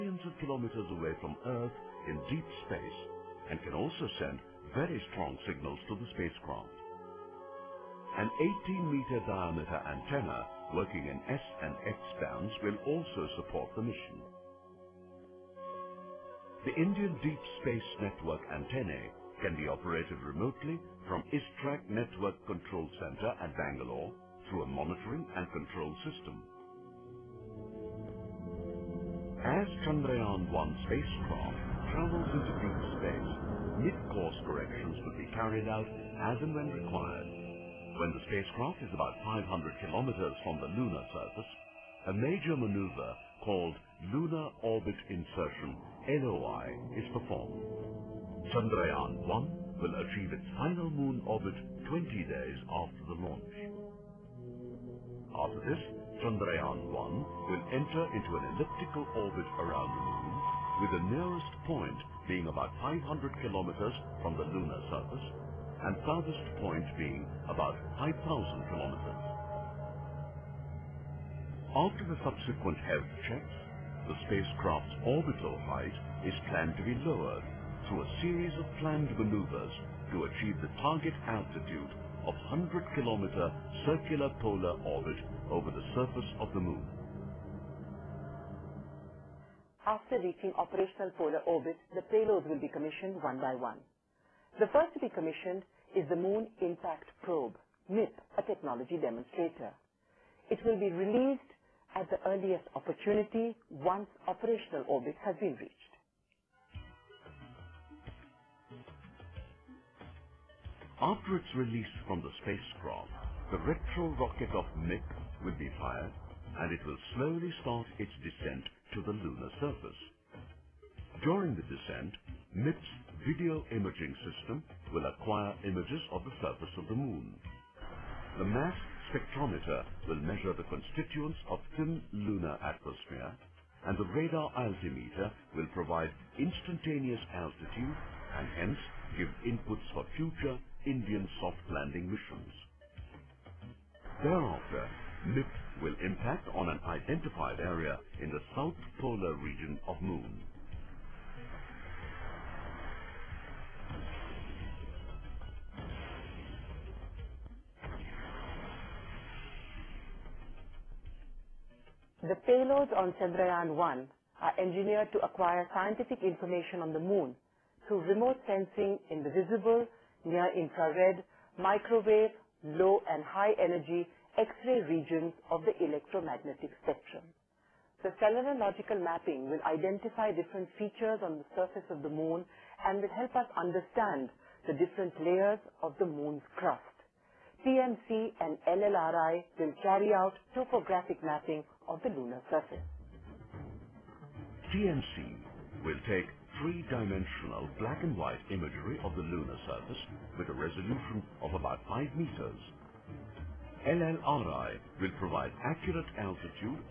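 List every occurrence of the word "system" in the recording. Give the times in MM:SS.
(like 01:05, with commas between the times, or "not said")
00:26, 02:04.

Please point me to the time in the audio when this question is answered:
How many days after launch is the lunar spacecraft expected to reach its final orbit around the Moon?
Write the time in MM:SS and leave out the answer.
00:51.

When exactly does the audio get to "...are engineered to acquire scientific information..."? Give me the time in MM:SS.
02:44.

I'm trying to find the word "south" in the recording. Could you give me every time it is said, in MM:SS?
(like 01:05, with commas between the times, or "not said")
02:28.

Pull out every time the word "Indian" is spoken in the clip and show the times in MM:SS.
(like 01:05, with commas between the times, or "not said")
00:16, 02:20.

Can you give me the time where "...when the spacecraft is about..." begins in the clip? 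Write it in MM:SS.
00:37.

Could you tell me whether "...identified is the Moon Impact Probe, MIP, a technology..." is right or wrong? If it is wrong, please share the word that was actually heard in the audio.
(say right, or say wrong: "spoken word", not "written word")
wrong: "commissioned", not "identified".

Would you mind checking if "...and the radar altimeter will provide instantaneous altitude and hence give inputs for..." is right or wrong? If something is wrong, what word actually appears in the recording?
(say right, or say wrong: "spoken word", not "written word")
right.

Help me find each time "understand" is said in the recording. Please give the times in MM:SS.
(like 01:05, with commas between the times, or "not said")
03:03.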